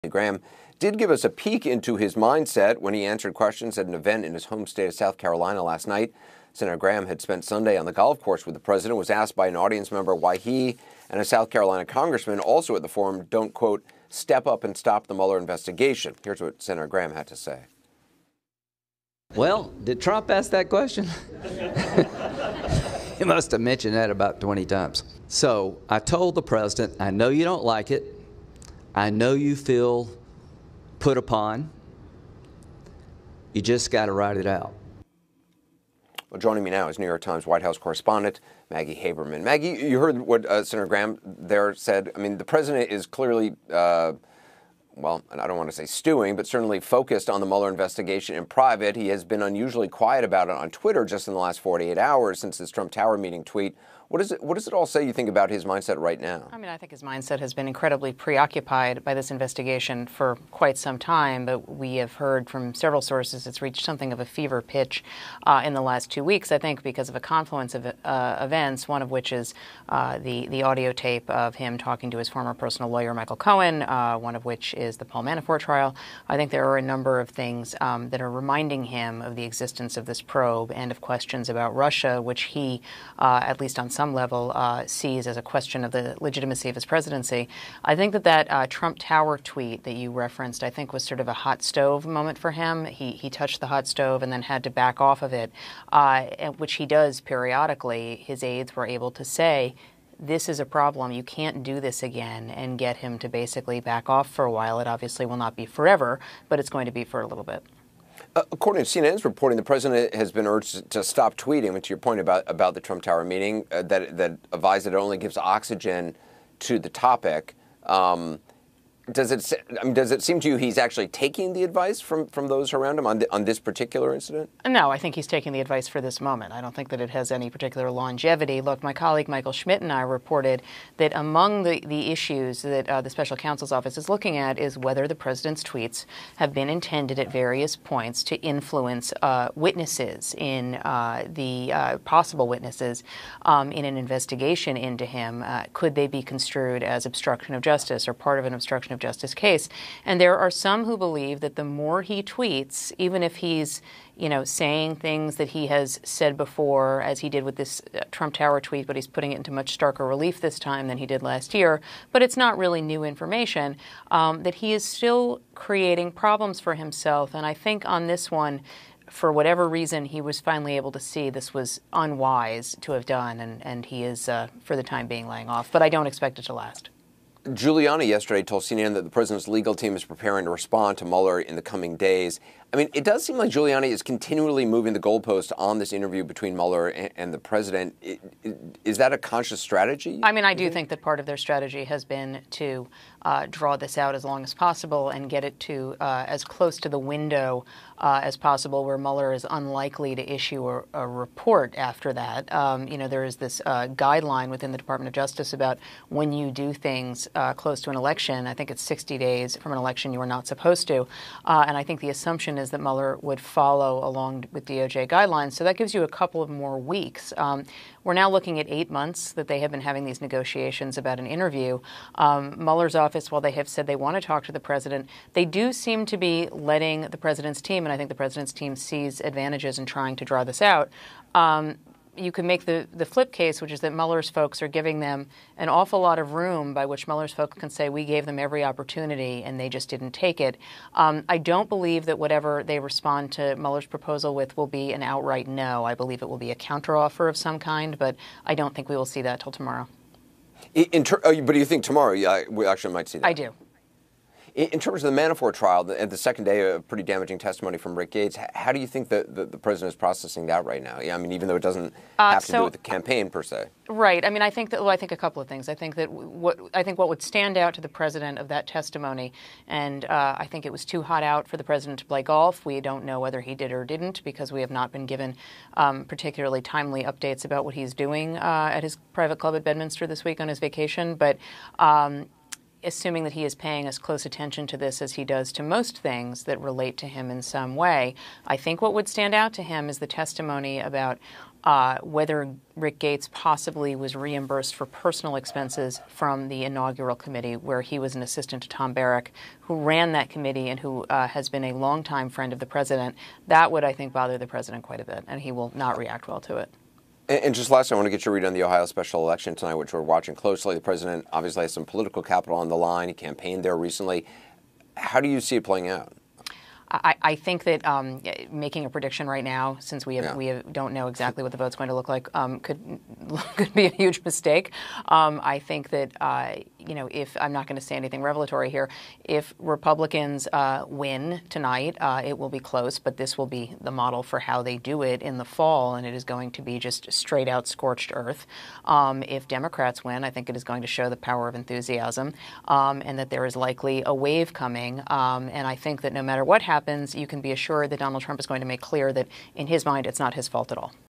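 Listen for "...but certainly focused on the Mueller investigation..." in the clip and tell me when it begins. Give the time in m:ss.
0:46.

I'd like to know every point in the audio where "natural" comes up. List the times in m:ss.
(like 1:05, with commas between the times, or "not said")
not said.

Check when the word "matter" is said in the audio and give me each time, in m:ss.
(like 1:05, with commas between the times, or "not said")
5:46.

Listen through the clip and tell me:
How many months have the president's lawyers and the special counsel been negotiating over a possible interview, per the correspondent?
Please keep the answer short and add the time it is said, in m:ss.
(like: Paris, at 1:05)
8, at 3:38.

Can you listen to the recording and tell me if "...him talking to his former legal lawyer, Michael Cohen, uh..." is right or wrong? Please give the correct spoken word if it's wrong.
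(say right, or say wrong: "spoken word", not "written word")
wrong: "personal", not "legal".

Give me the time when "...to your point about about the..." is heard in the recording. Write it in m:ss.
1:51.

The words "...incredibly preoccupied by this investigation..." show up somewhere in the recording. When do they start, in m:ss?
0:57.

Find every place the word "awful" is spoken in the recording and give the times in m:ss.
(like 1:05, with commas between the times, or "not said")
3:55.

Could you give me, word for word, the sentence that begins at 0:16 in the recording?
Here's what Senator Graham had to say.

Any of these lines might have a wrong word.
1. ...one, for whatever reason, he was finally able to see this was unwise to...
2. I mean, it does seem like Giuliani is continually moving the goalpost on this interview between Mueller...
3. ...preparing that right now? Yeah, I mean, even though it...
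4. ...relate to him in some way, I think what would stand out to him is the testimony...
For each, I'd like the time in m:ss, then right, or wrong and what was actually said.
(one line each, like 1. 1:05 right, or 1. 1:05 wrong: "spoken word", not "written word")
1. 2:48 right
2. 3:02 right
3. 4:19 wrong: "processing", not "preparing"
4. 4:46 right.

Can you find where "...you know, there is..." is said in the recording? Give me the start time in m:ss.
3:22.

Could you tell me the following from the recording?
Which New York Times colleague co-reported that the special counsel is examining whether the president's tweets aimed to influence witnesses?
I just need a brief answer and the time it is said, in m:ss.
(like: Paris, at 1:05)
Michael Schmidt, at 2:09.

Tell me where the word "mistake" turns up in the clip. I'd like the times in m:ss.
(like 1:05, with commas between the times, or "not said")
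5:24.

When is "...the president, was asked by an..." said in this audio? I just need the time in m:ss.
0:08.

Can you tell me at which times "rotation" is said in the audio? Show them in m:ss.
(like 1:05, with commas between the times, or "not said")
not said.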